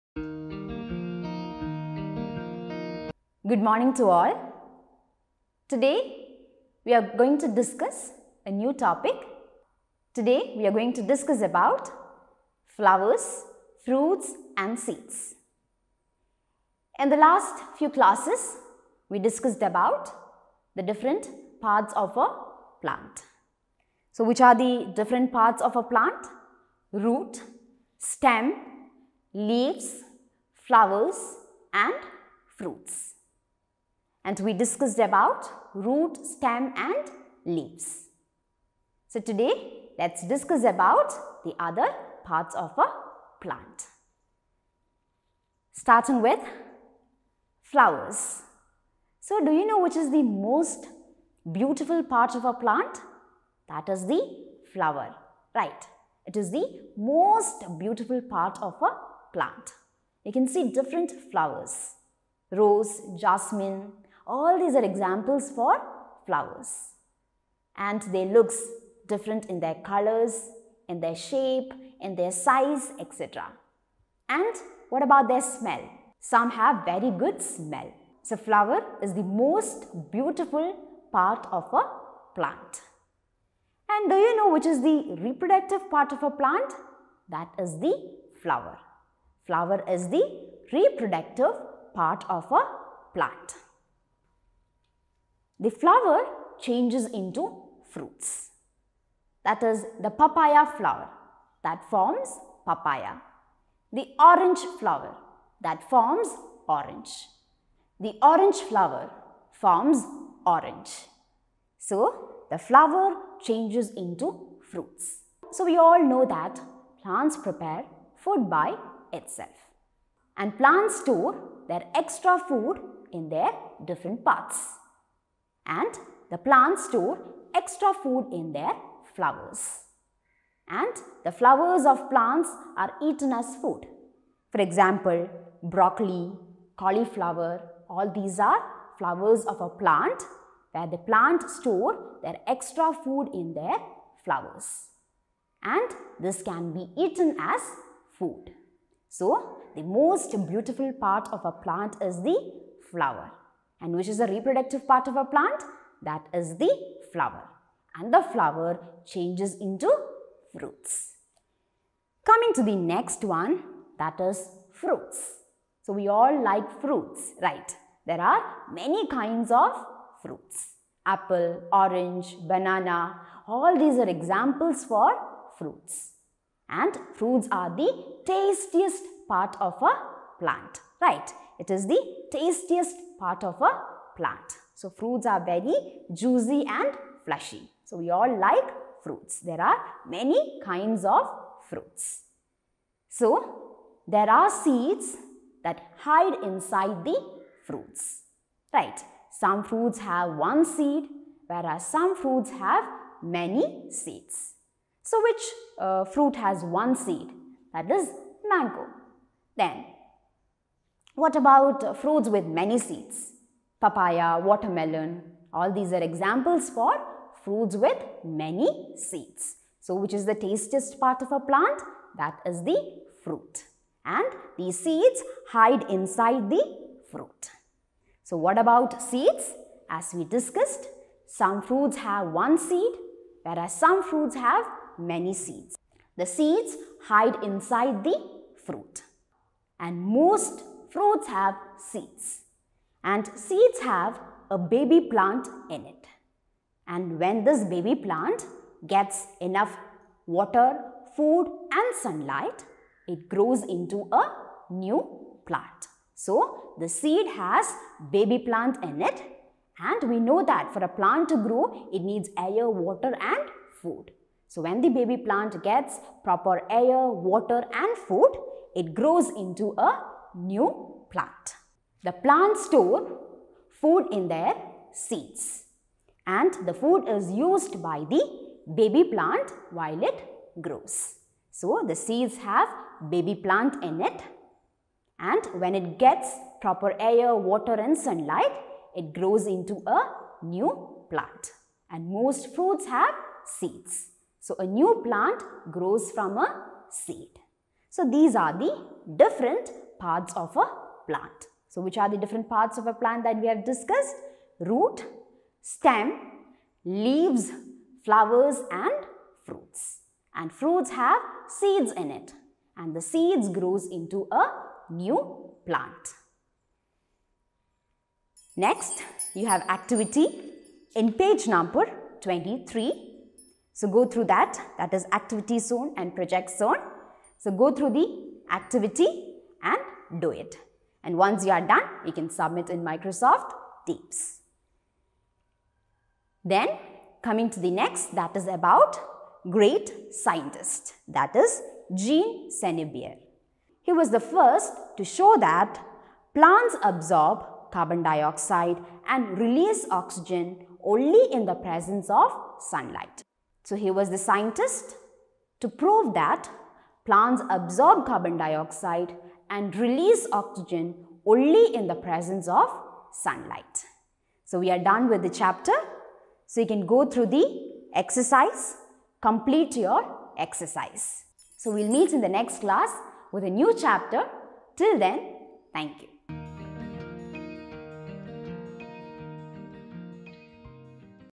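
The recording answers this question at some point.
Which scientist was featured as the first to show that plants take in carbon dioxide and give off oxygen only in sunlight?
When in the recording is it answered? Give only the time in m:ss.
5:41.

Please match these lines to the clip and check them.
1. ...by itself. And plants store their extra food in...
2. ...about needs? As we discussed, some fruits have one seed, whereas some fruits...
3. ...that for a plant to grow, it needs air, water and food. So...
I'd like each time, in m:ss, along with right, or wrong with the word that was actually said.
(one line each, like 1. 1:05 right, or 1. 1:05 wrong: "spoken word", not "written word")
1. 1:58 right
2. 3:48 wrong: "seeds", not "needs"
3. 4:20 right.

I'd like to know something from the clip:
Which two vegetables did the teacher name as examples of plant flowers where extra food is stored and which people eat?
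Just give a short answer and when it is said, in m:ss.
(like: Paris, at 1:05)
broccoli, cauliflower, at 2:15.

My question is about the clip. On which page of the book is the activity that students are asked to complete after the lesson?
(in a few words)
23.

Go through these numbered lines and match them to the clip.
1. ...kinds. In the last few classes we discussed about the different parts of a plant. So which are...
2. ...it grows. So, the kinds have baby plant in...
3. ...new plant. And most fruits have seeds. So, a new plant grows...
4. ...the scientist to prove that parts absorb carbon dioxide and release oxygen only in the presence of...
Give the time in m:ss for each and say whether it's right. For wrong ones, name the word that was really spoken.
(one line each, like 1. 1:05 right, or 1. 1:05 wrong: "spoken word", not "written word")
1. 0:14 wrong: "seeds", not "kinds"
2. 4:40 wrong: "seeds", not "kinds"
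3. 4:50 right
4. 5:54 wrong: "plants", not "parts".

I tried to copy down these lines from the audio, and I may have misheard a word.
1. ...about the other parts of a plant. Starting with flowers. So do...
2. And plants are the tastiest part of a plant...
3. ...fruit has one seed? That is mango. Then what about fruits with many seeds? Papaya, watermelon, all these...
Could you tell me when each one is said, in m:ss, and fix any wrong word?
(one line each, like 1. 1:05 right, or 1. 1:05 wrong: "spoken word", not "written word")
1. 0:40 right
2. 2:56 wrong: "fruits", not "plants"
3. 3:26 right.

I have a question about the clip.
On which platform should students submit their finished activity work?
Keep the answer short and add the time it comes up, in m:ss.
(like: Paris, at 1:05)
Microsoft Teams, at 5:32.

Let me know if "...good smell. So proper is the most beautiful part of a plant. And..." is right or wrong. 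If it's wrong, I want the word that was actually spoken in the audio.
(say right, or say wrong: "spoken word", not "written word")
wrong: "flower", not "proper".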